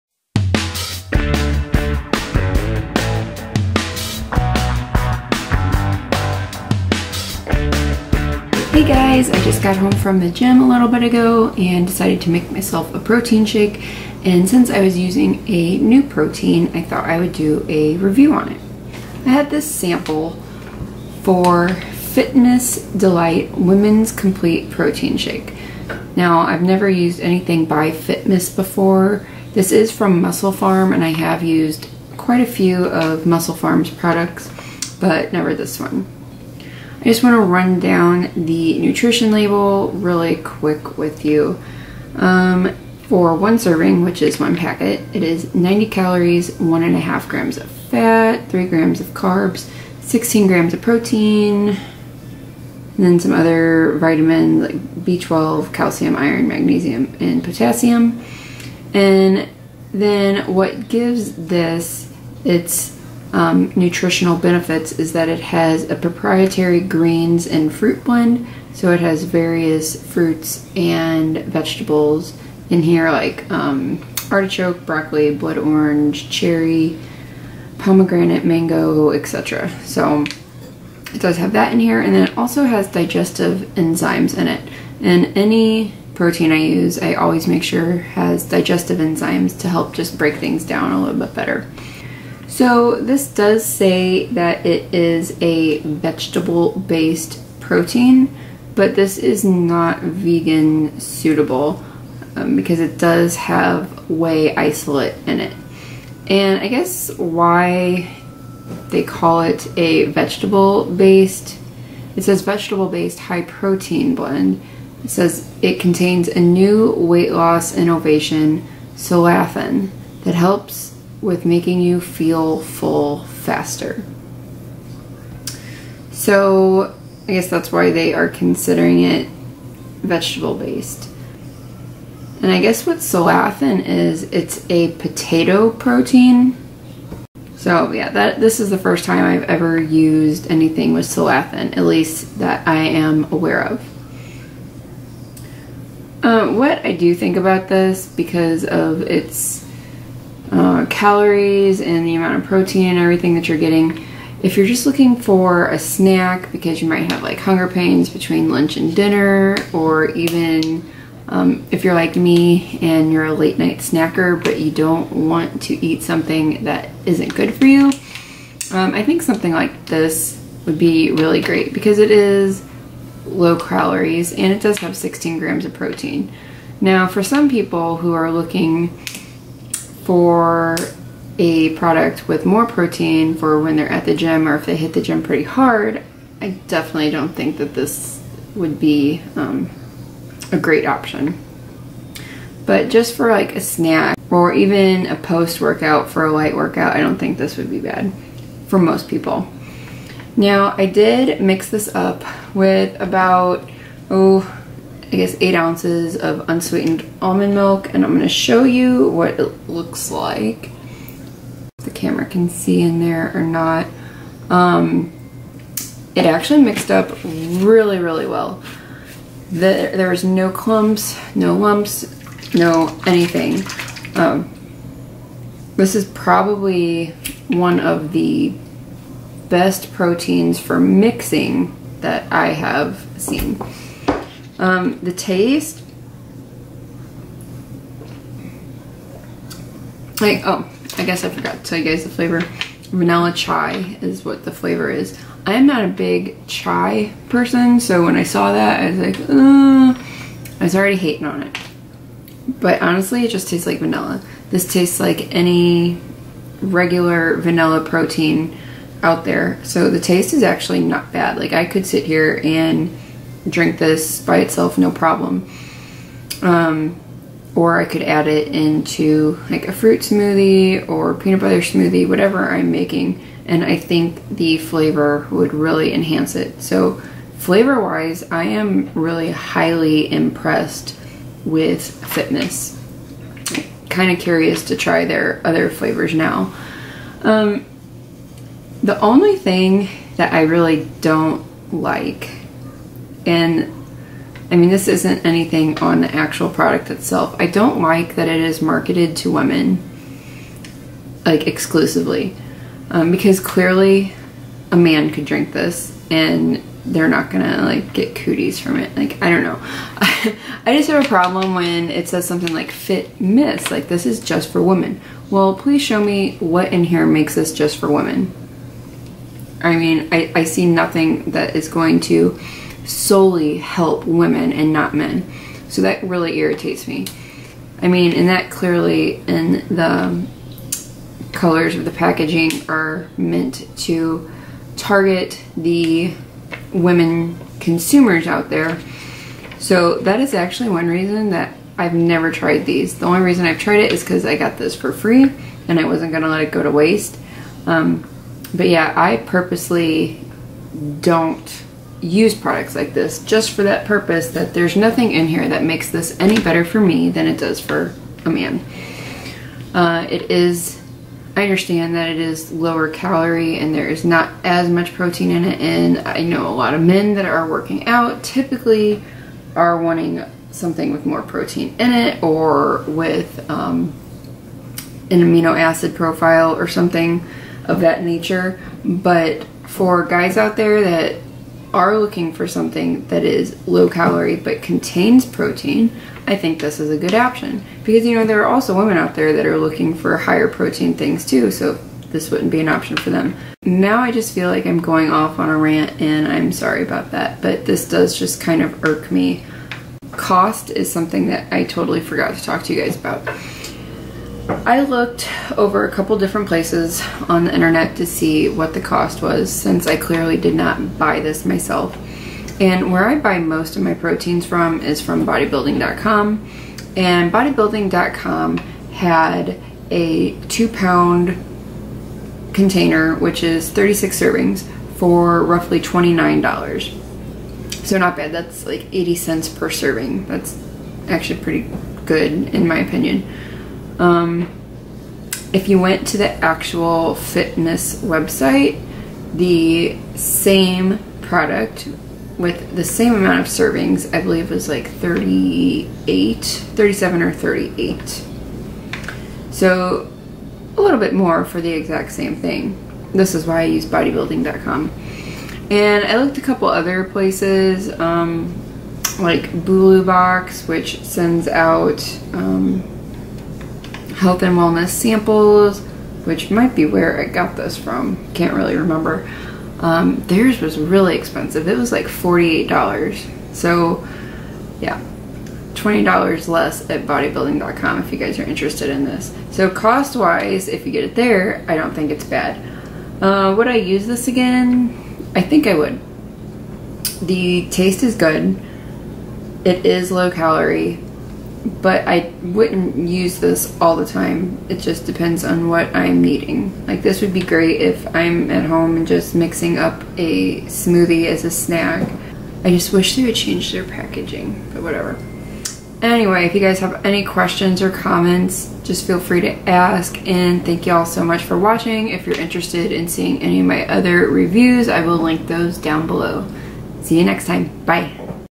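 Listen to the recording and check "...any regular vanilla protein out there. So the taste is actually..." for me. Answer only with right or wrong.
right.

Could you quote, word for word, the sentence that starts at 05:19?
I mean, I, I see nothing that is going to solely help women and not men.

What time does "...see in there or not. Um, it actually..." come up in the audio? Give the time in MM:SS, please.
03:32.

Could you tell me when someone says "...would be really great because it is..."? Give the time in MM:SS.
02:50.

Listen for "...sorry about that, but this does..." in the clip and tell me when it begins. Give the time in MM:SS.
06:36.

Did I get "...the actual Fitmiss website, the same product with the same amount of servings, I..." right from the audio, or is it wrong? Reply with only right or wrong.
right.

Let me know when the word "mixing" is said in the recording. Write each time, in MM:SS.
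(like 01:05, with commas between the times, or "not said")
03:50, 08:19.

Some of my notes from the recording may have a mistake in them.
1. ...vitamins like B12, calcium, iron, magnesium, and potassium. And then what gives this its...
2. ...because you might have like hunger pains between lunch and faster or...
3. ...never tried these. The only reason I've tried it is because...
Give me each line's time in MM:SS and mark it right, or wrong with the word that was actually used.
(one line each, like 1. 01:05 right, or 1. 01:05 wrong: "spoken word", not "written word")
1. 00:53 right
2. 02:36 wrong: "dinner", not "faster"
3. 05:41 right.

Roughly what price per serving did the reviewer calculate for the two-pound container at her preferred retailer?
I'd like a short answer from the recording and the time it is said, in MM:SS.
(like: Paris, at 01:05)
80 cents, at 07:08.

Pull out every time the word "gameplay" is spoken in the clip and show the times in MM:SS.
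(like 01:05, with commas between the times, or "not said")
not said.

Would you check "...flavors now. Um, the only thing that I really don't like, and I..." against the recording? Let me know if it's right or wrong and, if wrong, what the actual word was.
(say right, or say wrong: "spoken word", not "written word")
right.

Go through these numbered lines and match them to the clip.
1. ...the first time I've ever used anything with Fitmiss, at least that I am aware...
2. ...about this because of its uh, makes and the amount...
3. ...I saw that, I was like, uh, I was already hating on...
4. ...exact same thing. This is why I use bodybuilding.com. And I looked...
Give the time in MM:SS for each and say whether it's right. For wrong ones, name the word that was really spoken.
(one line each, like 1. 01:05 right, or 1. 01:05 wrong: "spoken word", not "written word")
1. 02:18 wrong: "Solathin", not "Fitmiss"
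2. 02:27 wrong: "calories", not "makes"
3. 04:08 right
4. 07:31 right.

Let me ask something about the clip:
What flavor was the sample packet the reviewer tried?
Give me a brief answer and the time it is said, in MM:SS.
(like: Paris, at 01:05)
Vanilla chai, at 04:02.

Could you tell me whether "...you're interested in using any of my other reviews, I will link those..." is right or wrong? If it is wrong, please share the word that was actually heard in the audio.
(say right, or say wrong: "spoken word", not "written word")
wrong: "seeing", not "using".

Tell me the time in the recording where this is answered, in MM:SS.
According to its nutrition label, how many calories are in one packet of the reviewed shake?
00:45.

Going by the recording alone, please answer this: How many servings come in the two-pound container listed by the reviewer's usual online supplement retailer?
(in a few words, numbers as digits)
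36.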